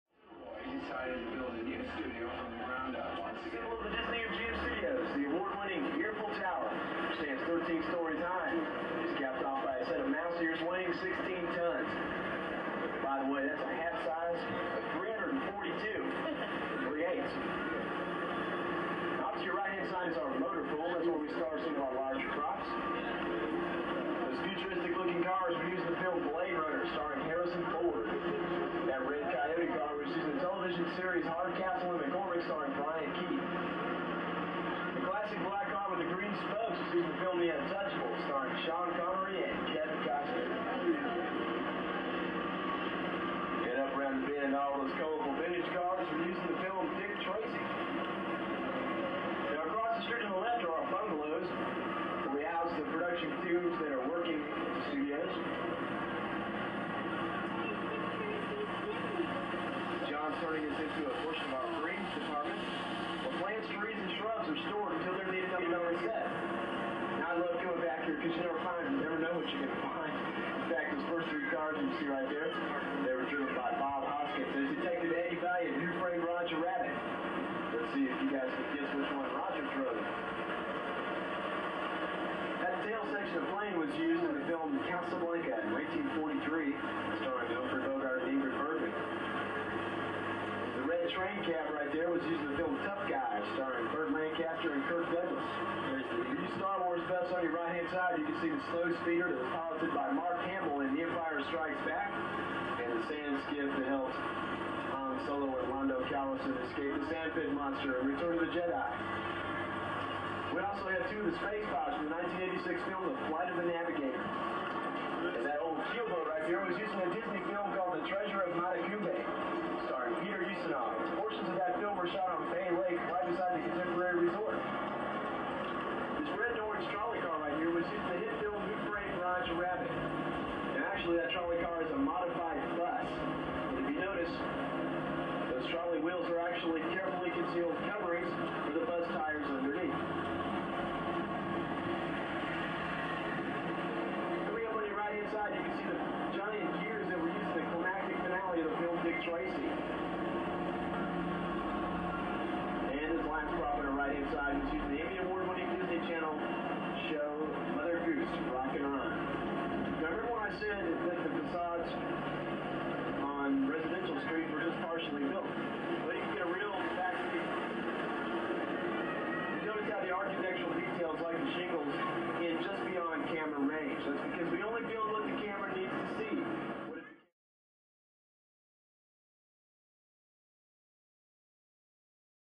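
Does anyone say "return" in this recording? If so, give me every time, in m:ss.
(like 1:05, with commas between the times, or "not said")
1:48.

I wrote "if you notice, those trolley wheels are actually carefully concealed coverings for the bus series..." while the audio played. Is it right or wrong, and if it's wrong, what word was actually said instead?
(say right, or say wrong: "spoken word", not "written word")
wrong: "tires", not "series".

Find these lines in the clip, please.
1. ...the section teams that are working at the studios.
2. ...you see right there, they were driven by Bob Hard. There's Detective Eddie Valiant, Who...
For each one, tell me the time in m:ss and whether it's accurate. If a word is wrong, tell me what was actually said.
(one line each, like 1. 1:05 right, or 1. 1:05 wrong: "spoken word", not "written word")
1. 0:52 wrong: "production", not "section"
2. 1:11 wrong: "Hoskins", not "Hard".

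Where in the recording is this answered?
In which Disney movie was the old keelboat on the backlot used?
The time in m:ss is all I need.
1:57.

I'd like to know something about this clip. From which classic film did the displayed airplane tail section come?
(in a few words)
Casablanca.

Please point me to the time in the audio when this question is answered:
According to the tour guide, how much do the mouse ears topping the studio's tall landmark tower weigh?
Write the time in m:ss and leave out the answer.
0:10.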